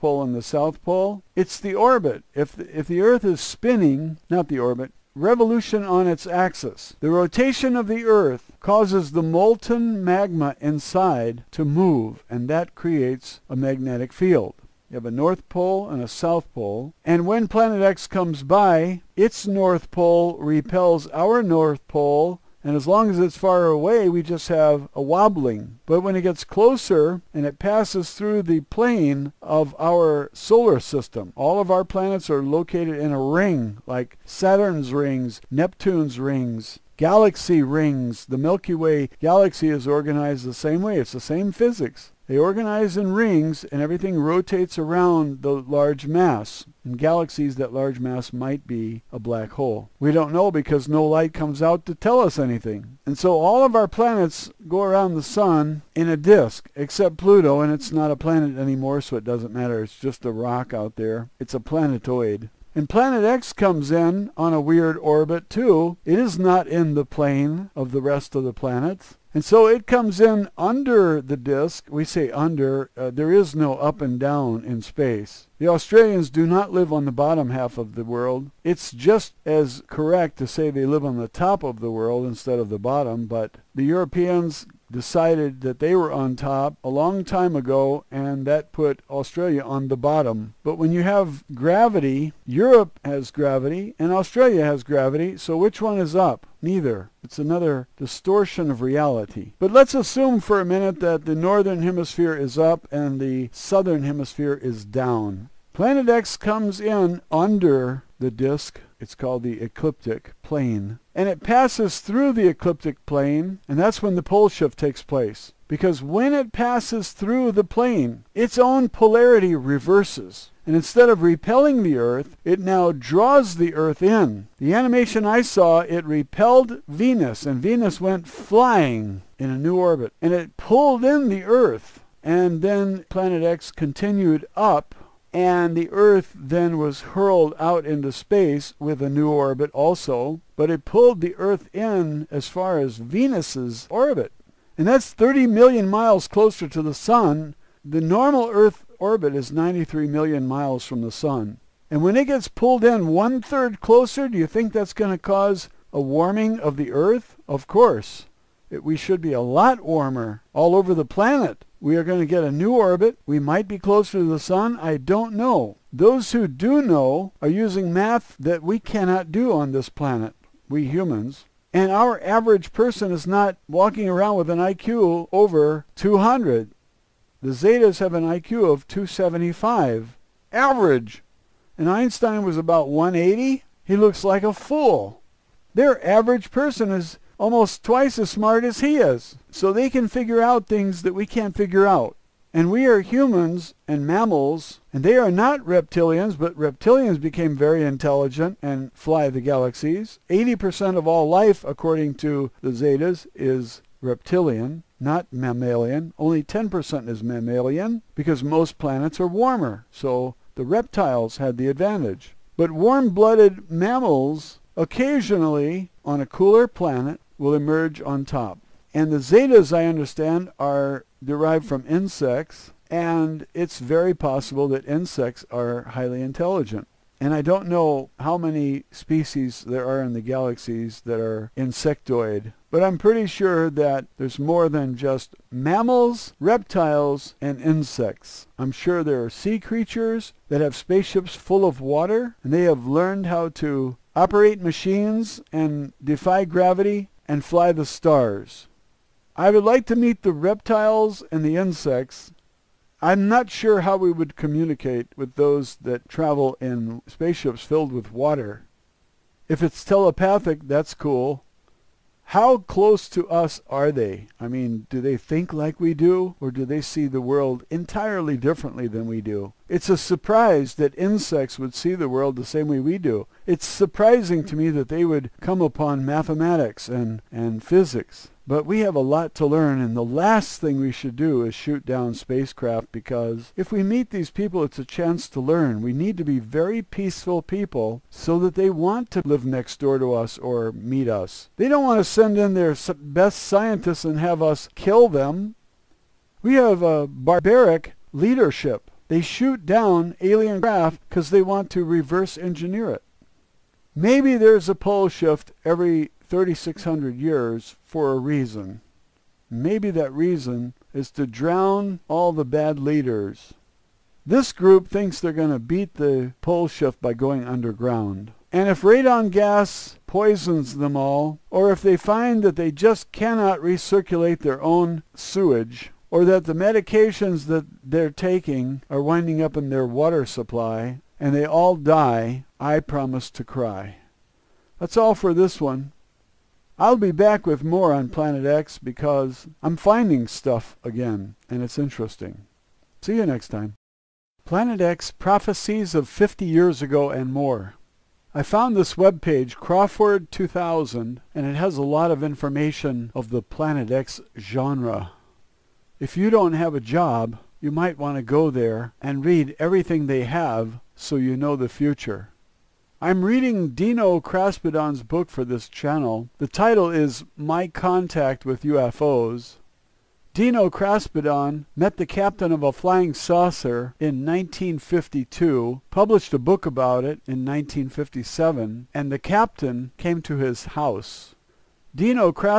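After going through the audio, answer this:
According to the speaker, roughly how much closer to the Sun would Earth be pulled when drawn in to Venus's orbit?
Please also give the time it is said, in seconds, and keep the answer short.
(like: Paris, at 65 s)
30 million miles, at 145 s.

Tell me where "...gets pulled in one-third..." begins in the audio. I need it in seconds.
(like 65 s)
152 s.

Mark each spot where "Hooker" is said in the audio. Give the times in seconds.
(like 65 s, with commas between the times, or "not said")
not said.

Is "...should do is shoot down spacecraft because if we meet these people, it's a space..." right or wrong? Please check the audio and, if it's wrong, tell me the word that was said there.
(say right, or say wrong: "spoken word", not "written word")
wrong: "chance", not "space".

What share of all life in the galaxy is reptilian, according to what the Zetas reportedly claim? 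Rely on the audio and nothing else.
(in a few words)
80%.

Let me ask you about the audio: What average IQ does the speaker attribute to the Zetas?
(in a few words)
275.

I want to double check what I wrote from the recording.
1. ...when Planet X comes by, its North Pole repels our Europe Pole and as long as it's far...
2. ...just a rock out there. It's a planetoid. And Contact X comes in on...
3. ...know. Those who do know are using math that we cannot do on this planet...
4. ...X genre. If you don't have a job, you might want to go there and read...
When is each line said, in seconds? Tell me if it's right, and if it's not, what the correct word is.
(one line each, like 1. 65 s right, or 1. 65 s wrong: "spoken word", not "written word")
1. 17 s wrong: "North", not "Europe"
2. 59 s wrong: "Planet", not "Contact"
3. 165 s right
4. 353 s right.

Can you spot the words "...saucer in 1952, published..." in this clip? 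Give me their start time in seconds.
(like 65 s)
373 s.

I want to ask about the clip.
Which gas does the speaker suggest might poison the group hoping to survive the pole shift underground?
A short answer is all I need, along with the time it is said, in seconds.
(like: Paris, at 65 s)
radon, at 318 s.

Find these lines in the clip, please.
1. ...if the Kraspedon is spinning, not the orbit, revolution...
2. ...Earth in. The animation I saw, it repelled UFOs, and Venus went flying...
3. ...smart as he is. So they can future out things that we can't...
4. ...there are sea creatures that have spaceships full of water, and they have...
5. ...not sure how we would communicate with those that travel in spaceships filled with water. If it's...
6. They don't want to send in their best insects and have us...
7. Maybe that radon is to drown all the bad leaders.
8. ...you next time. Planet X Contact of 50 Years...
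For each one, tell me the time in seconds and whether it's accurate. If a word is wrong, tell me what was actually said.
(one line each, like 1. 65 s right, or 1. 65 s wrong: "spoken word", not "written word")
1. 2 s wrong: "Earth", not "Kraspedon"
2. 123 s wrong: "Venus", not "UFOs"
3. 188 s wrong: "figure", not "future"
4. 239 s right
5. 253 s right
6. 291 s wrong: "scientists", not "insects"
7. 309 s wrong: "reason", not "radon"
8. 343 s wrong: "Prophecies", not "Contact".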